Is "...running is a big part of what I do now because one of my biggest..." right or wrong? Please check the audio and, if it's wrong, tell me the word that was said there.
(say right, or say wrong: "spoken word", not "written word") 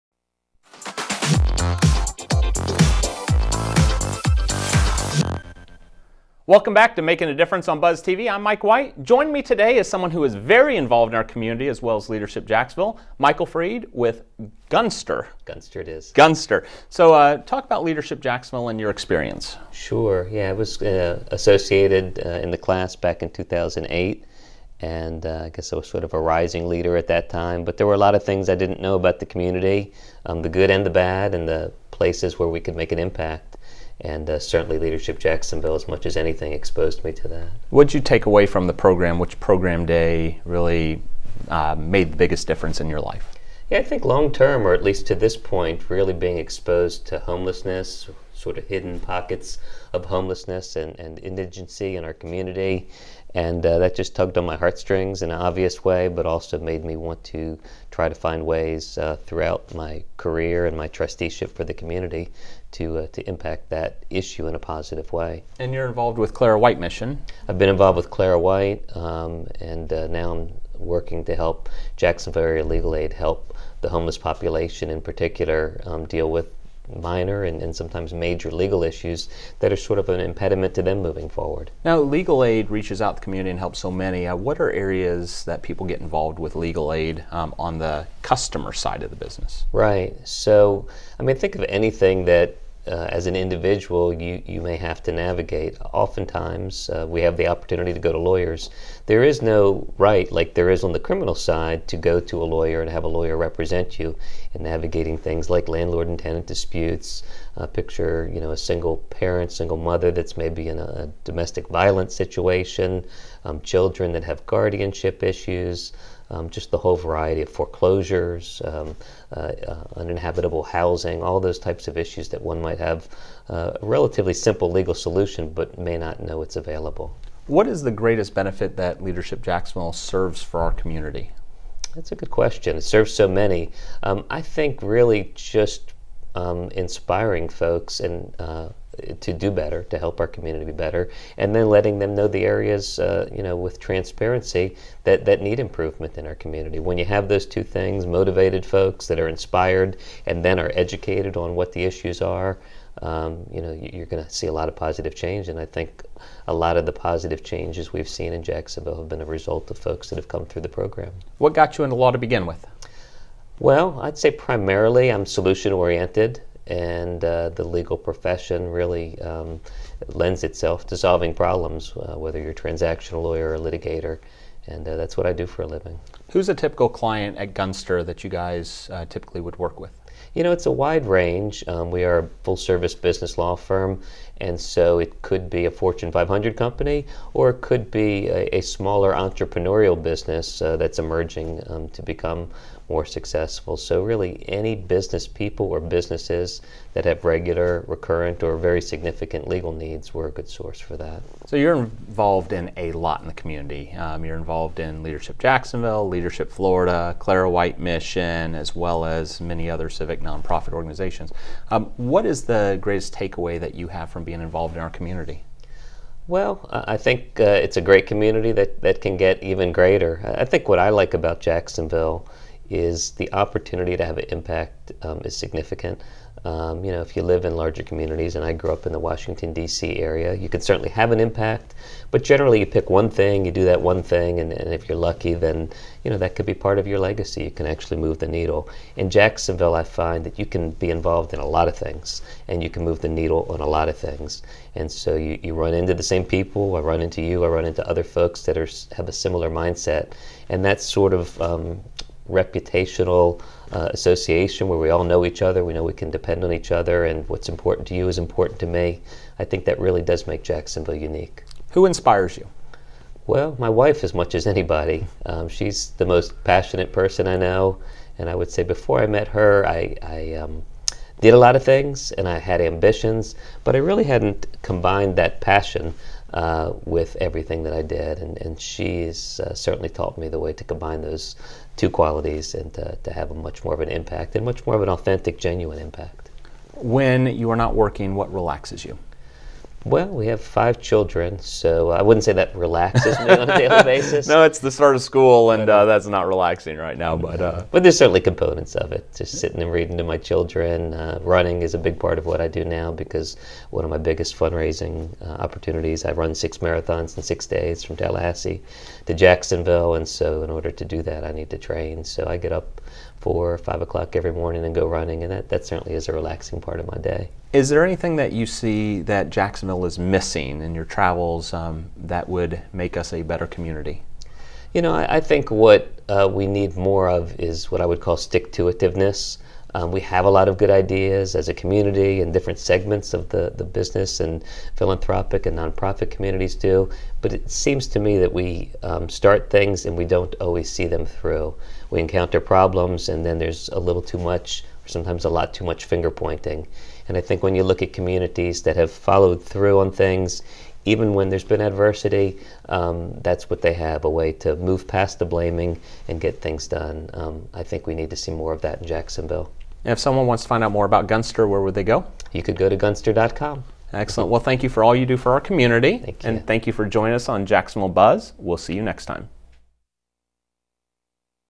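right.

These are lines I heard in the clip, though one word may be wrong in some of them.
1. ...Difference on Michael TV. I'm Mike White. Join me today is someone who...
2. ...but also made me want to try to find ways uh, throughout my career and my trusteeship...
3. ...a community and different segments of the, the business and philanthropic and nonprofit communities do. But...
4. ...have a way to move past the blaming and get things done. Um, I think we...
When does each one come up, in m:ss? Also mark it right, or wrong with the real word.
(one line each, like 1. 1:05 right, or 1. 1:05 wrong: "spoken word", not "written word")
1. 0:07 wrong: "Buzz", not "Michael"
2. 0:56 right
3. 5:31 right
4. 5:53 right.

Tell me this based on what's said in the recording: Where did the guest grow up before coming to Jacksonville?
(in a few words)
Washington, D.C. area.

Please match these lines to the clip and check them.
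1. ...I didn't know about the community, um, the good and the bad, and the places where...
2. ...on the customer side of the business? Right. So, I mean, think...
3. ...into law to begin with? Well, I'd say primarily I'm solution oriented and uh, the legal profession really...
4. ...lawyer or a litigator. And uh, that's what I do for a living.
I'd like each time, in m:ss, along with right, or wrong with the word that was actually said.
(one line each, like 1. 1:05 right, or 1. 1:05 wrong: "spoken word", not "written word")
1. 0:28 right
2. 1:27 right
3. 2:41 right
4. 2:53 right.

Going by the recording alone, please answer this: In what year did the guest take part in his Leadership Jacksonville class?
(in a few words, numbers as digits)
2008.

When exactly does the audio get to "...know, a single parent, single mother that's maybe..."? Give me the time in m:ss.
1:48.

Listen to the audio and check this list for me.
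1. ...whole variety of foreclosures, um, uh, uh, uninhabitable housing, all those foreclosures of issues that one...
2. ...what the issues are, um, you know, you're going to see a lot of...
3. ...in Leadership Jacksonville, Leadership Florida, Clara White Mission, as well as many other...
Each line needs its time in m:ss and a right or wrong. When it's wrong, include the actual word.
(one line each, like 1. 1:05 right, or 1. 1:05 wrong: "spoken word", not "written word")
1. 1:56 wrong: "types", not "foreclosures"
2. 2:31 right
3. 3:24 right.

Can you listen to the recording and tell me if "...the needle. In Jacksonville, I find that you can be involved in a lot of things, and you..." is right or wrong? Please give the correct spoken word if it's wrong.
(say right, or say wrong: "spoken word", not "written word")
right.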